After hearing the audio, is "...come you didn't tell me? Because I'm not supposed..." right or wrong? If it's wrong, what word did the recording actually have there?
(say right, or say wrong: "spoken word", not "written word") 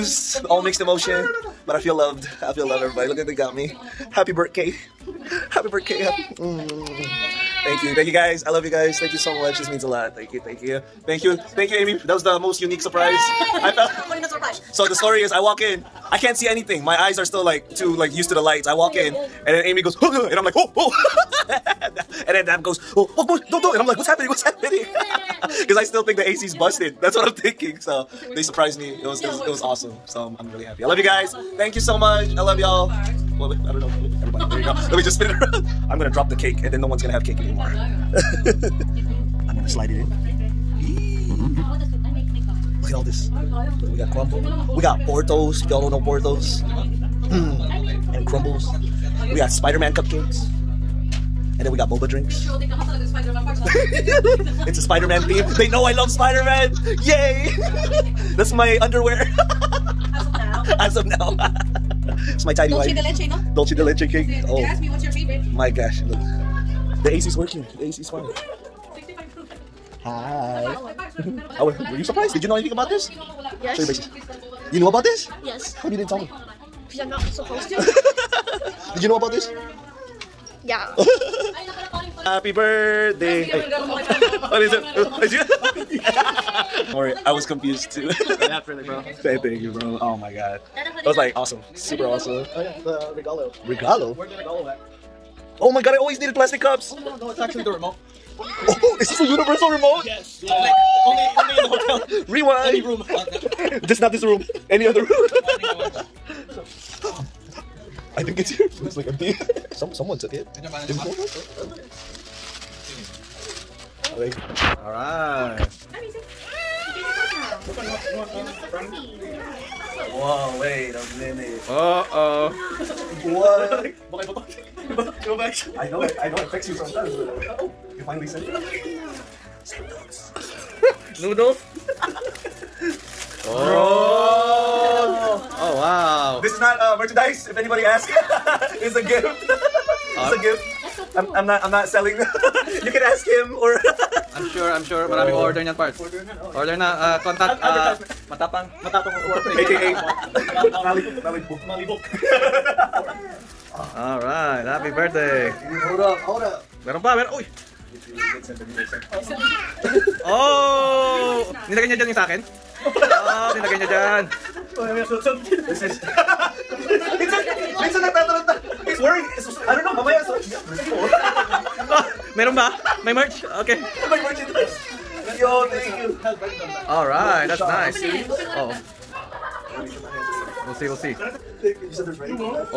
right.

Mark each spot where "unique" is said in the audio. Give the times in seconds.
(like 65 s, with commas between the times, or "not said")
12 s.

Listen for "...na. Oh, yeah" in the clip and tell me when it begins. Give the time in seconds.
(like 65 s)
146 s.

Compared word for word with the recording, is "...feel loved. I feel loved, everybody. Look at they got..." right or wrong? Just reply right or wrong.
right.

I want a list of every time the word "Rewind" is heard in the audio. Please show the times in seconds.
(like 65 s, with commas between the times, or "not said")
102 s.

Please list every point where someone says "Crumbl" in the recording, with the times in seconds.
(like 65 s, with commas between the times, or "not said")
44 s, 48 s.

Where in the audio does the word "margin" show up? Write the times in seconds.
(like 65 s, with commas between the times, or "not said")
not said.